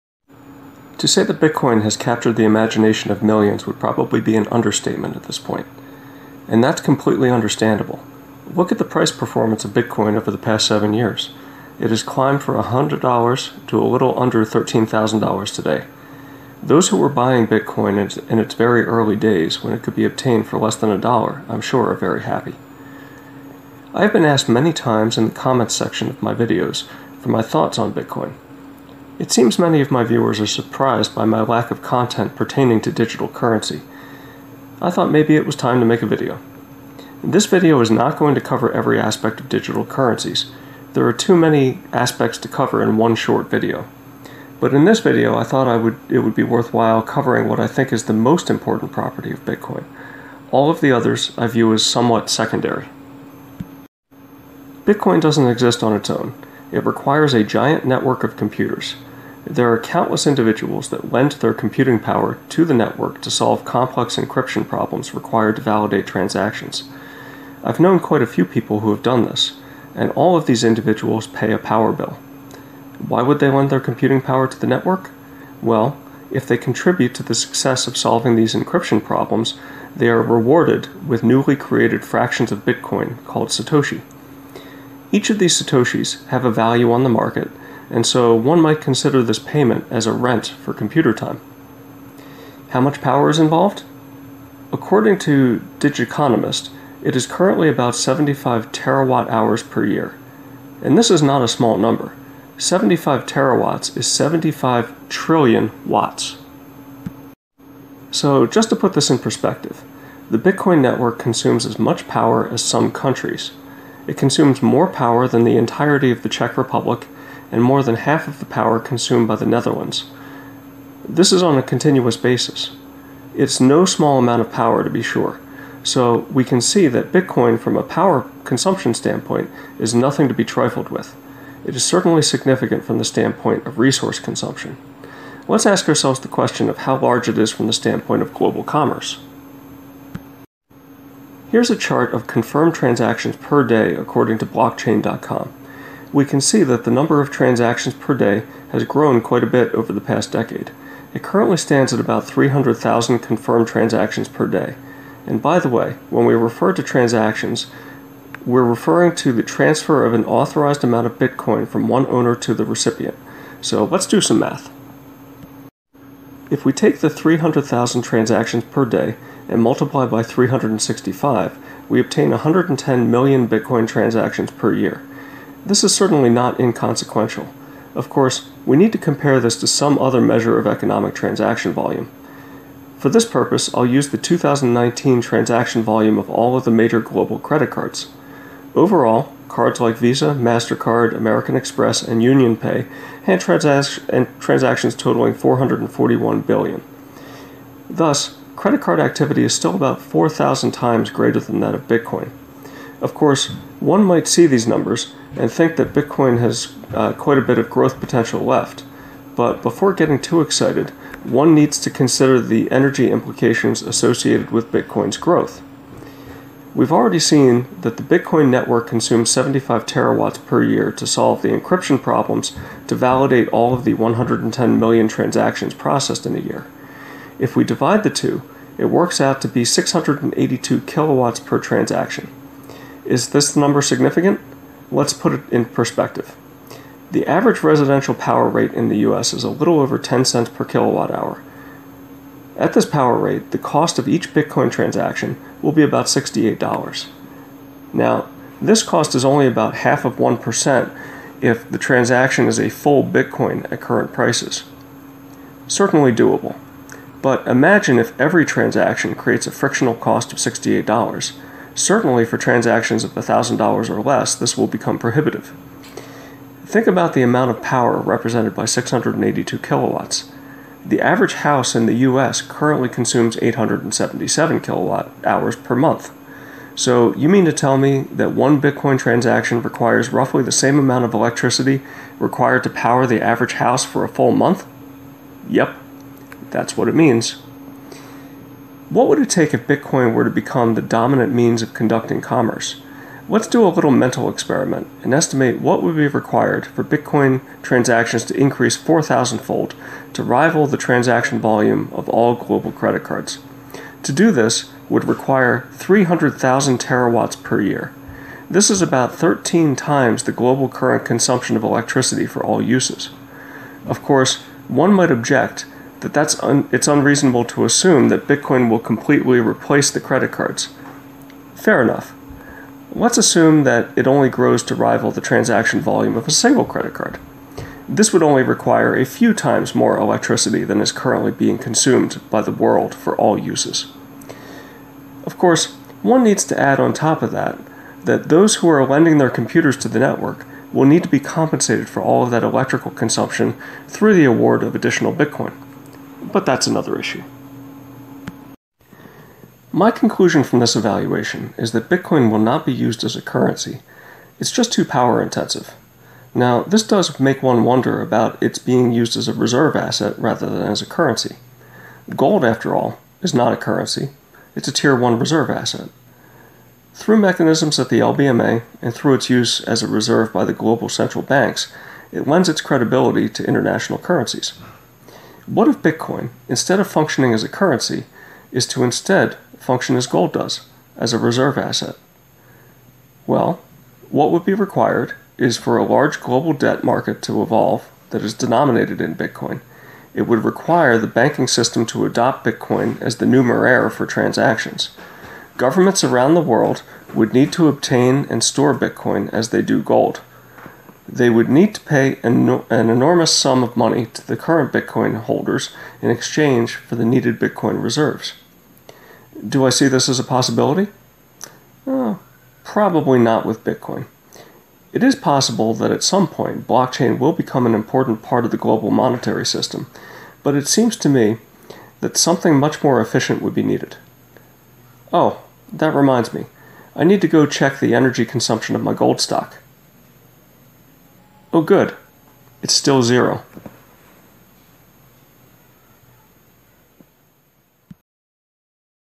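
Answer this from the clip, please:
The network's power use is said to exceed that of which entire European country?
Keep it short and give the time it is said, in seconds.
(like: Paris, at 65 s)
Czech Republic, at 116 s.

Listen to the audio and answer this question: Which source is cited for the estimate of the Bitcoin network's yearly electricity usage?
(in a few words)
Digiconomist.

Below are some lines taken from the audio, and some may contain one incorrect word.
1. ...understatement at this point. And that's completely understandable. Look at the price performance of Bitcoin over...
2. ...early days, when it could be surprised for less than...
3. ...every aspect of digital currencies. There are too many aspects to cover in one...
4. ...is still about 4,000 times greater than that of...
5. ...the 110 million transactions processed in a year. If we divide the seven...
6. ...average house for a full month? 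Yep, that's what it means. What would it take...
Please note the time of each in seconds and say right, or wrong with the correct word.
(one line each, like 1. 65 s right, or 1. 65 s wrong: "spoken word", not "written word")
1. 4 s right
2. 18 s wrong: "obtained", not "surprised"
3. 38 s right
4. 199 s right
5. 223 s wrong: "two", not "seven"
6. 283 s right.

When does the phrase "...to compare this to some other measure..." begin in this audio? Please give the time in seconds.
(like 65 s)
178 s.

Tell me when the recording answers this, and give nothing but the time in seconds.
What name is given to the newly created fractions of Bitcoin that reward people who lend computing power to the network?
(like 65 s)
83 s.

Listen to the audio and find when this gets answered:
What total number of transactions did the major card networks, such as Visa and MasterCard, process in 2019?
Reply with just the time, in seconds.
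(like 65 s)
195 s.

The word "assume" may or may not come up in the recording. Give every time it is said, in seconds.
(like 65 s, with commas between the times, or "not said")
317 s, 323 s.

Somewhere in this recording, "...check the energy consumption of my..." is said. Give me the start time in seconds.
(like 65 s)
427 s.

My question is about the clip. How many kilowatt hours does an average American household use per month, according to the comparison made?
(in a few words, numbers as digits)
877.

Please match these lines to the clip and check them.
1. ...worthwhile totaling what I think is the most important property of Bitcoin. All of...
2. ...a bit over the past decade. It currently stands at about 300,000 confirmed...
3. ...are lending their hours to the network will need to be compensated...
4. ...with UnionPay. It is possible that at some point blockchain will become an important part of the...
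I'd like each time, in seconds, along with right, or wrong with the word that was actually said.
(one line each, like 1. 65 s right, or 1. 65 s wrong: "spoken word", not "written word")
1. 46 s wrong: "covering", not "totaling"
2. 149 s right
3. 338 s wrong: "computers", not "hours"
4. 413 s wrong: "Bitcoin", not "UnionPay".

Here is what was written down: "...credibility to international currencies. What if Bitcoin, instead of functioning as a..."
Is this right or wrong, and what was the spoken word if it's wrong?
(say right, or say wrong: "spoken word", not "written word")
right.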